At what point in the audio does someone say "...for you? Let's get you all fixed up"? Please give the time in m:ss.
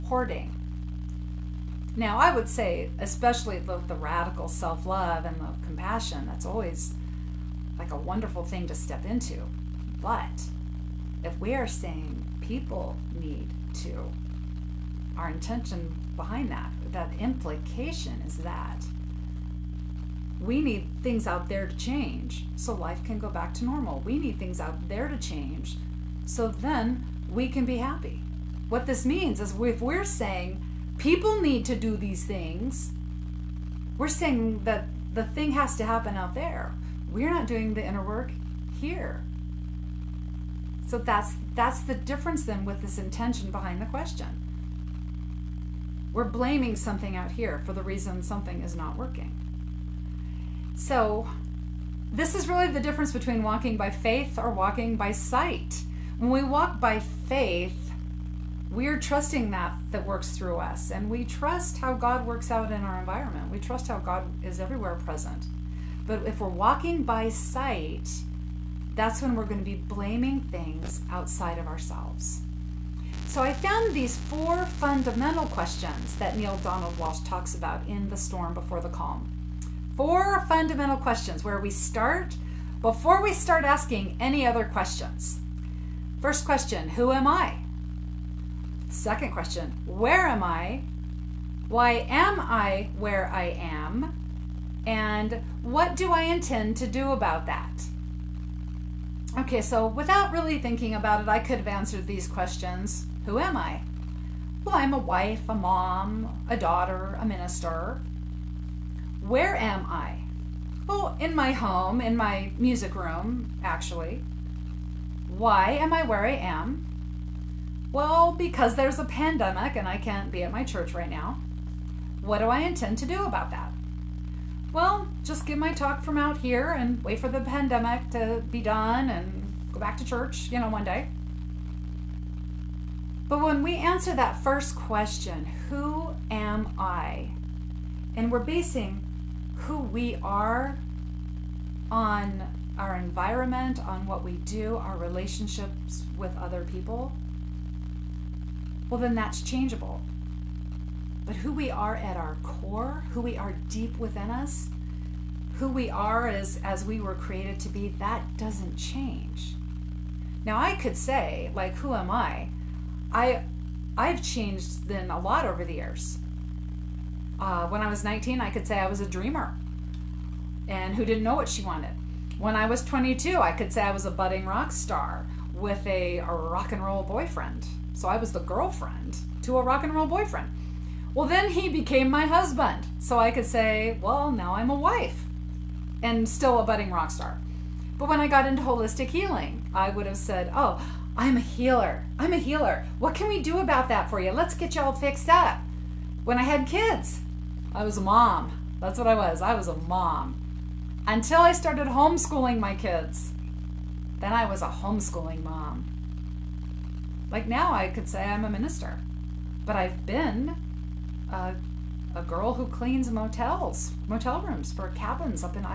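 3:14.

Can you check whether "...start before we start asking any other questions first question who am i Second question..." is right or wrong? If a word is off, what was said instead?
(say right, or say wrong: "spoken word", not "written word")
right.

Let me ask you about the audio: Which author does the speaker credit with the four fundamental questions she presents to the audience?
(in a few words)
Neale Donald Walsch.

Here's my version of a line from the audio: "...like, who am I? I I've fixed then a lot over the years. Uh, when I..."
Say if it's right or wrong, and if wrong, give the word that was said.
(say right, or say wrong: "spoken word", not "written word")
wrong: "changed", not "fixed".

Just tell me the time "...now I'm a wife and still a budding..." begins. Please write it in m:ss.
3:04.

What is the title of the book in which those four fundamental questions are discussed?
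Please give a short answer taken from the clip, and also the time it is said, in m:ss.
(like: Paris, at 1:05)
The Storm Before the Calm, at 1:18.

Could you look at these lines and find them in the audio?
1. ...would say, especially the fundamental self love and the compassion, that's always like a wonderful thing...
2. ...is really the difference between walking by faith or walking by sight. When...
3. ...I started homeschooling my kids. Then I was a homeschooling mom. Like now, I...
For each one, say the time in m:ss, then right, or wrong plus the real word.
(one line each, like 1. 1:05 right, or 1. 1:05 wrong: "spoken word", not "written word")
1. 0:02 wrong: "radical", not "fundamental"
2. 0:52 right
3. 3:21 right.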